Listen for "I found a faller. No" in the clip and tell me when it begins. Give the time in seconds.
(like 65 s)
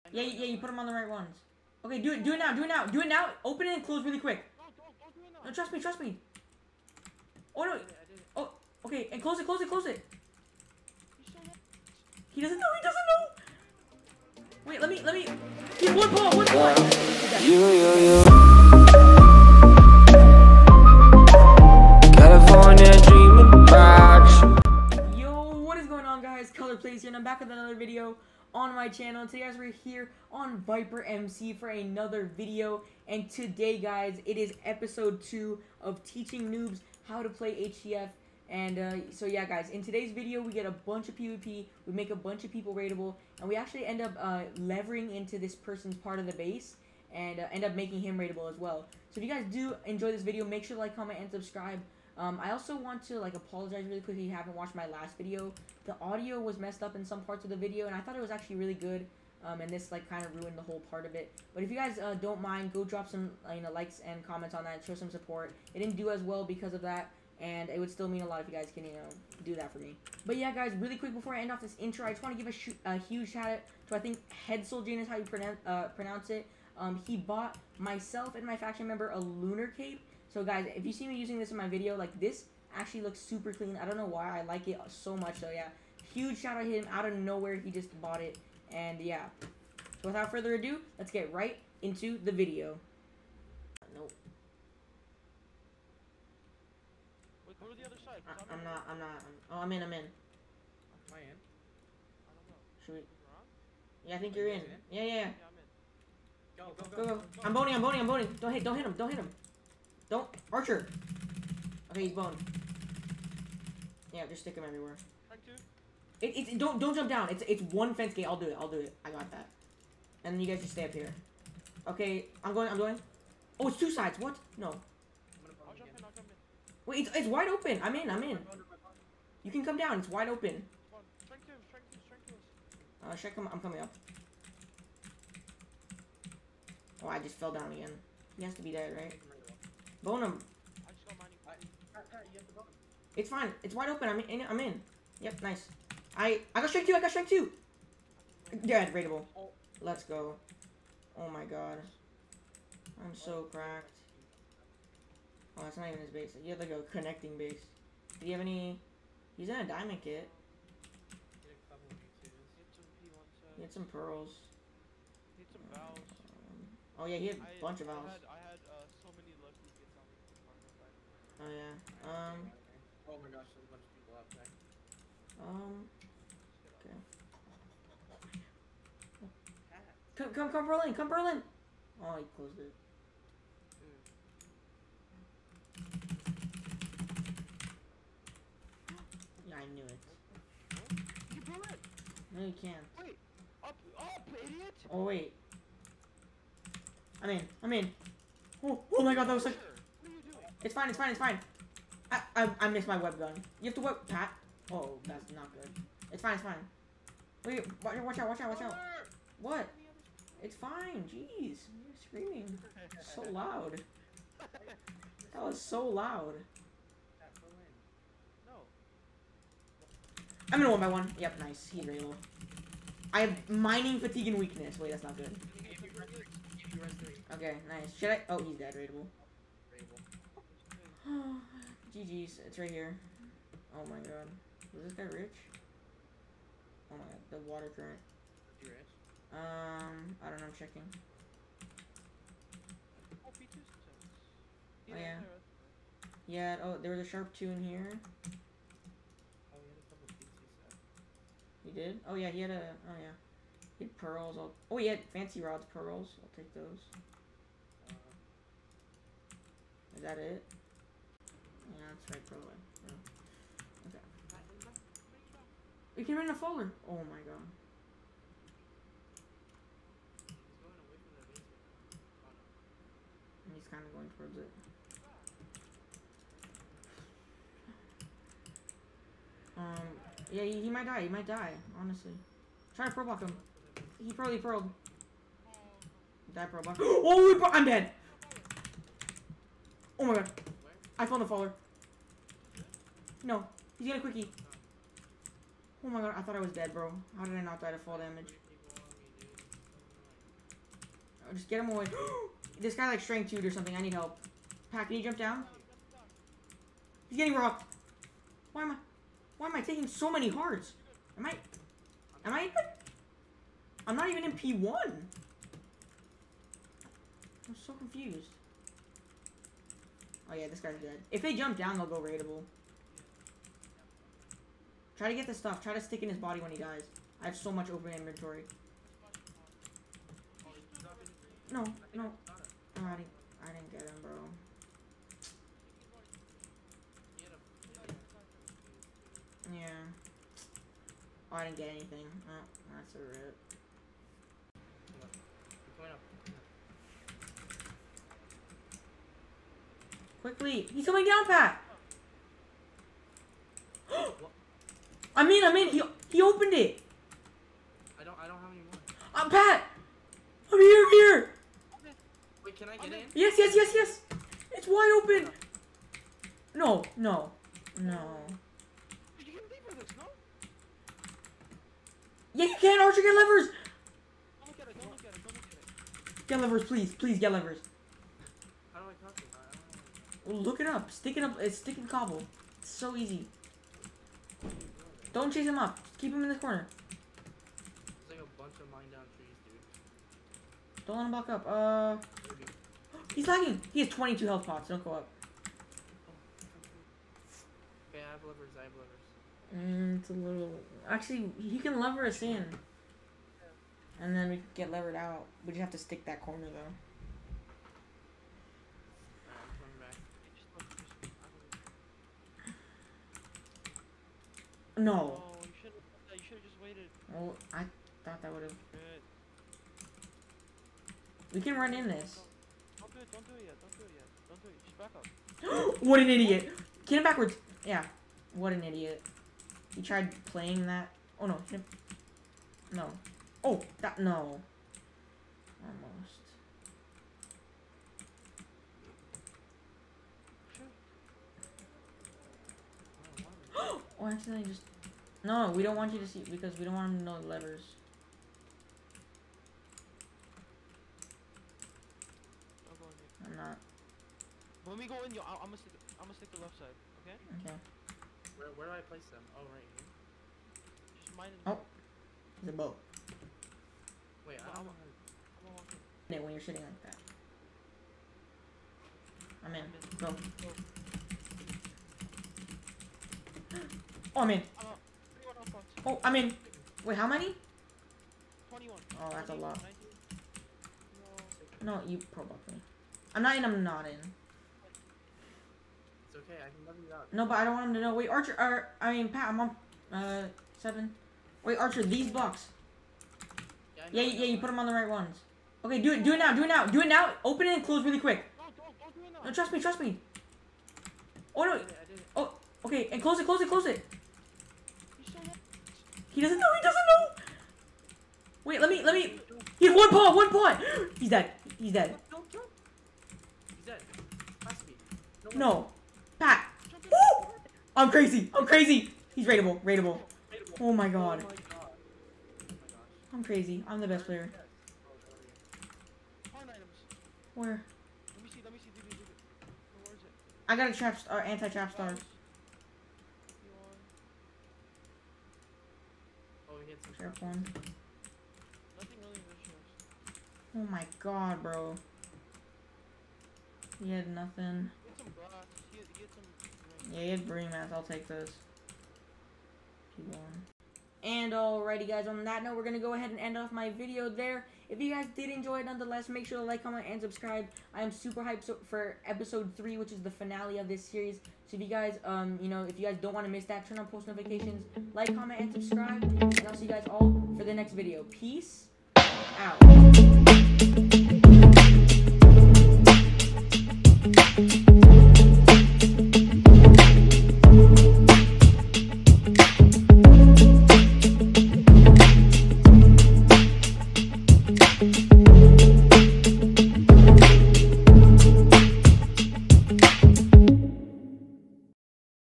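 290 s.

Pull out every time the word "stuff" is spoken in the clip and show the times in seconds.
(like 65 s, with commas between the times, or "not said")
325 s.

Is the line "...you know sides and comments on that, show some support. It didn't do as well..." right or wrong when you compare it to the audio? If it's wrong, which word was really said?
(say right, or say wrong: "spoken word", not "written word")
wrong: "likes", not "sides".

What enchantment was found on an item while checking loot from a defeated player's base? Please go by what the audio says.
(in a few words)
sharp 2.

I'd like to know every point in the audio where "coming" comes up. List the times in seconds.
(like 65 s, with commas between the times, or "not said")
133 s, 350 s.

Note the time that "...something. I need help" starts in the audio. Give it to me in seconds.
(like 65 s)
303 s.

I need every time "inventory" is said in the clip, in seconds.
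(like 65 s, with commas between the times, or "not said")
327 s.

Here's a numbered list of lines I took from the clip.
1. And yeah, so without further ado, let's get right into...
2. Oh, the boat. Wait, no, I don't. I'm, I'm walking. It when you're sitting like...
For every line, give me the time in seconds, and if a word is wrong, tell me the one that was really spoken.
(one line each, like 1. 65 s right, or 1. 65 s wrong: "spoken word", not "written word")
1. 88 s right
2. 461 s right.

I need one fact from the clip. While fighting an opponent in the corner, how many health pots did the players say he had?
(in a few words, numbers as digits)
22.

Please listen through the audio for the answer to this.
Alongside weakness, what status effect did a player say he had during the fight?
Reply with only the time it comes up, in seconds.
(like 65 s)
223 s.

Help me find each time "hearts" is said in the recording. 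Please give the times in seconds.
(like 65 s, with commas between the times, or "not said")
310 s.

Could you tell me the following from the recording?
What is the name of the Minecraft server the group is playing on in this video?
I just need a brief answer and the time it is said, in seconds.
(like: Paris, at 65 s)
Viper MC, at 30 s.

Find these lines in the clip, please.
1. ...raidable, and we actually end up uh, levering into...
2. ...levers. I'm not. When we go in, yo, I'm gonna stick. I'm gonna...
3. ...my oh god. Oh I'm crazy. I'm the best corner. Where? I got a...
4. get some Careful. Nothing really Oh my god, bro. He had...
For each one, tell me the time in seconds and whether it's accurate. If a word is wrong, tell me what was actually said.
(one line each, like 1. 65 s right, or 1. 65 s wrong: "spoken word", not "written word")
1. 42 s right
2. 447 s right
3. 520 s wrong: "player", not "corner"
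4. 536 s right.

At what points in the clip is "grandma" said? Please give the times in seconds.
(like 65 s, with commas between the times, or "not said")
not said.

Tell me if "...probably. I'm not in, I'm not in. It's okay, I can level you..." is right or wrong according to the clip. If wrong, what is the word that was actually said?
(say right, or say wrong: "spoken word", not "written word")
right.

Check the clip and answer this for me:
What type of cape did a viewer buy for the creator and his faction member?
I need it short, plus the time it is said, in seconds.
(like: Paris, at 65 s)
lunar cape, at 79 s.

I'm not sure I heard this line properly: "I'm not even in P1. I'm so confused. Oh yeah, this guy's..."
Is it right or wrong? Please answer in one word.
right.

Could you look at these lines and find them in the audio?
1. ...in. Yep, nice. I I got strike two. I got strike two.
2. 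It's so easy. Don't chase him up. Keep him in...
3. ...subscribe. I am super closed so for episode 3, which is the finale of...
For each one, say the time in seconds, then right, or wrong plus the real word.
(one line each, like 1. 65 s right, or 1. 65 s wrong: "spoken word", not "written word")
1. 144 s right
2. 382 s right
3. 557 s wrong: "hyped", not "closed".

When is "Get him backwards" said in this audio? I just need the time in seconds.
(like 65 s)
426 s.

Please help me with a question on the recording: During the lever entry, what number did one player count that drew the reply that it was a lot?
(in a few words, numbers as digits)
21.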